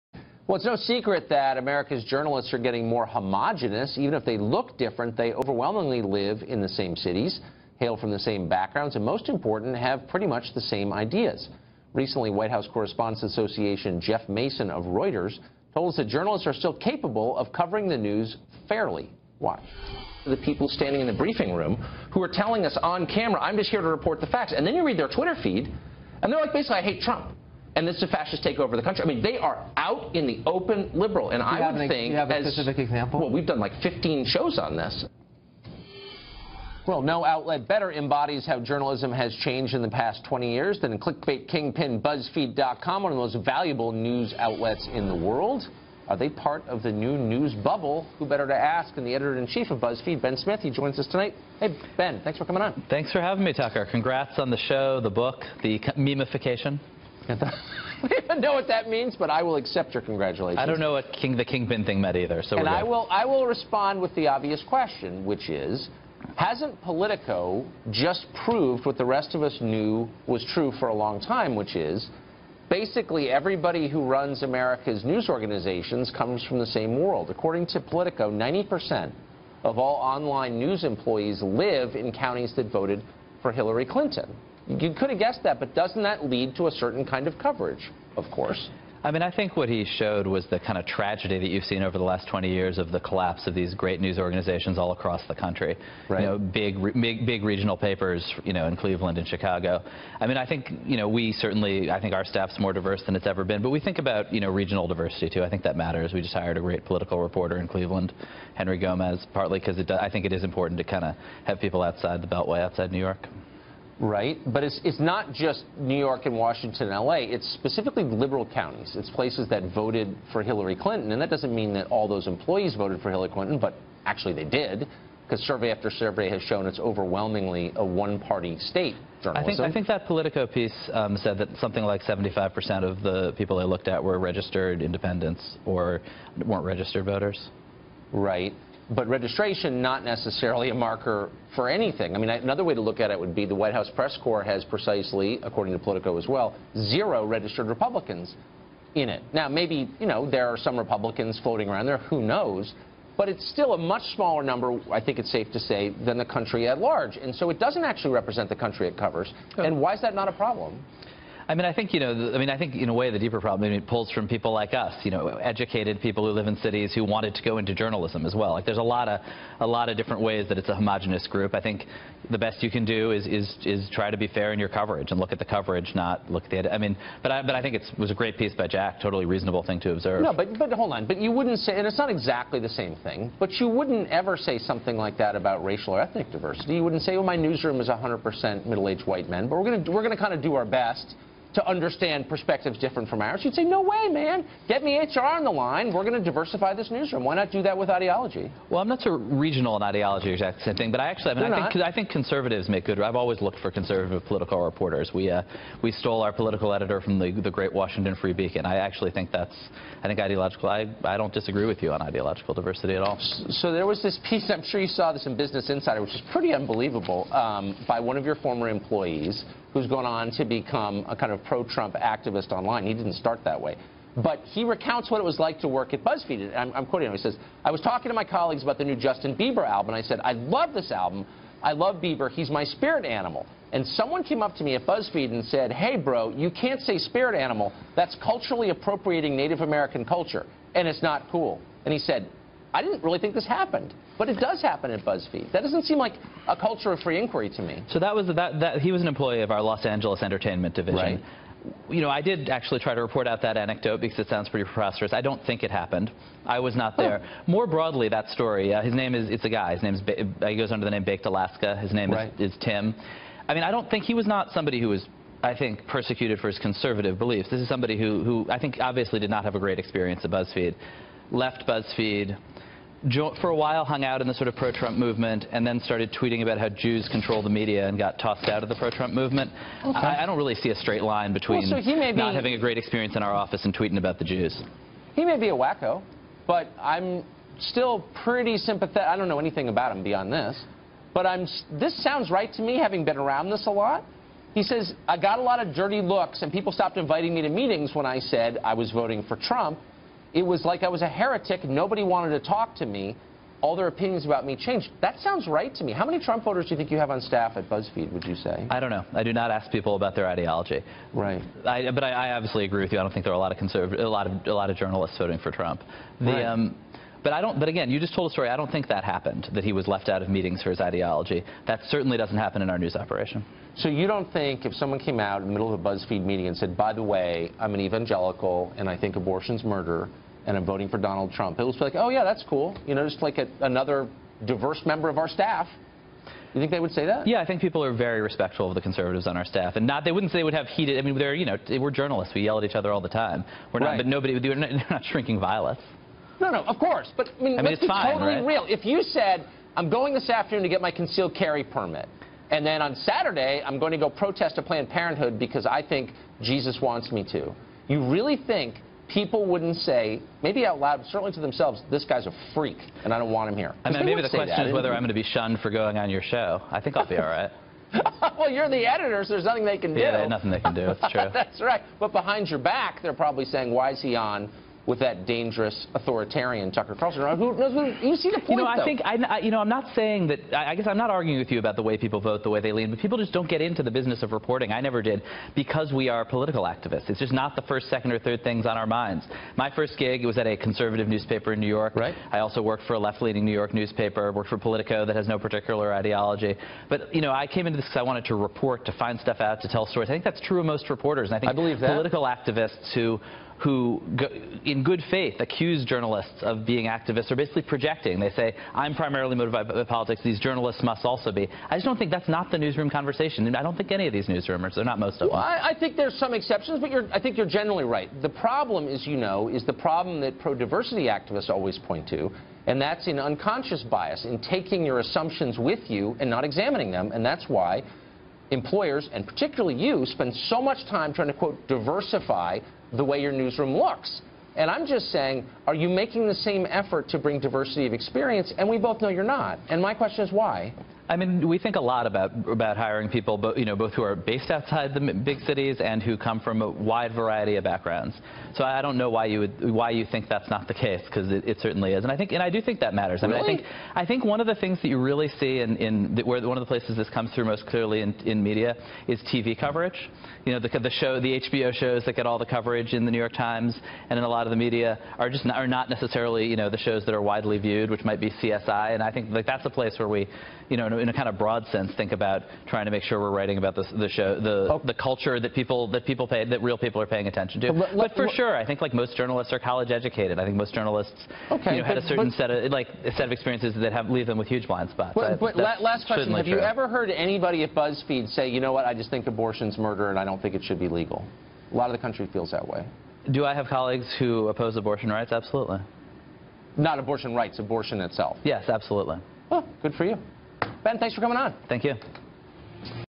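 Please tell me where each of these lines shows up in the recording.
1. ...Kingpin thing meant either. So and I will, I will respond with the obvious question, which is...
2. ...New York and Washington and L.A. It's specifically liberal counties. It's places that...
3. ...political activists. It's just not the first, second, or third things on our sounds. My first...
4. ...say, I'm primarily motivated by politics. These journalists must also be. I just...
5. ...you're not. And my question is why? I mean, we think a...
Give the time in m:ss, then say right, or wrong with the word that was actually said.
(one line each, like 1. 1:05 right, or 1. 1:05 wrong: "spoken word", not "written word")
1. 1:01 right
2. 1:55 right
3. 6:26 wrong: "minds", not "sounds"
4. 6:48 right
5. 7:19 right.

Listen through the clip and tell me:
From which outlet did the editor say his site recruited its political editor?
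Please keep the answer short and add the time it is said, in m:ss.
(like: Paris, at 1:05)
Washington Free Beacon, at 3:27.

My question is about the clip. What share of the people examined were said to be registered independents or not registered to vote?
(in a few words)
75%.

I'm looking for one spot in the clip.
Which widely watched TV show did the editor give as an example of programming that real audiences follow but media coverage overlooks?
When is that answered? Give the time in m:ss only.
7:48.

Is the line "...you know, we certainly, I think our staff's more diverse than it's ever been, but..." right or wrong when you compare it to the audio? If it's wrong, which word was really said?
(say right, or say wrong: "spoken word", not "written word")
right.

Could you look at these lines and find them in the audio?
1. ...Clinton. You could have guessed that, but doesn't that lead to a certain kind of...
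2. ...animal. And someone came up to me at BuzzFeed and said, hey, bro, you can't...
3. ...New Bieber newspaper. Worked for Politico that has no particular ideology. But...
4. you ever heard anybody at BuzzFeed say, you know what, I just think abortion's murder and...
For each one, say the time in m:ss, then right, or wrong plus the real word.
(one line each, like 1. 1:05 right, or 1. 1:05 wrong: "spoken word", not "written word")
1. 1:23 right
2. 3:53 right
3. 6:33 wrong: "York", not "Bieber"
4. 8:06 right.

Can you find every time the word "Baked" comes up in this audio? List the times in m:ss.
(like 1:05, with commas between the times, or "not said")
4:21.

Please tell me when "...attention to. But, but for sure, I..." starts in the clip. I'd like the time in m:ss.
7:57.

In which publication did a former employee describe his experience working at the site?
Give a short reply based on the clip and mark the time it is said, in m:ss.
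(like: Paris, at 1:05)
Business Insider, at 3:35.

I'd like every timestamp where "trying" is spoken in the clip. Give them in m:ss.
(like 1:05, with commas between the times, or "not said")
7:11, 7:52.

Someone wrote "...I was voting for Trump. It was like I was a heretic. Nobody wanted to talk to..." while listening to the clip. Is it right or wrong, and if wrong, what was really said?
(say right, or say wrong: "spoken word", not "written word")
right.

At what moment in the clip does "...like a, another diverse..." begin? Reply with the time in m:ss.
5:33.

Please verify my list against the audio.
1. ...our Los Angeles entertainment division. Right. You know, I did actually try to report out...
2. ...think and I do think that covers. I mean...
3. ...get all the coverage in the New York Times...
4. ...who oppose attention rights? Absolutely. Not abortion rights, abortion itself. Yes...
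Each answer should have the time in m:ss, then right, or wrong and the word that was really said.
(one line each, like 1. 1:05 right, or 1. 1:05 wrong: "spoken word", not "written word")
1. 4:09 right
2. 7:32 wrong: "matters", not "covers"
3. 7:42 right
4. 8:14 wrong: "abortion", not "attention".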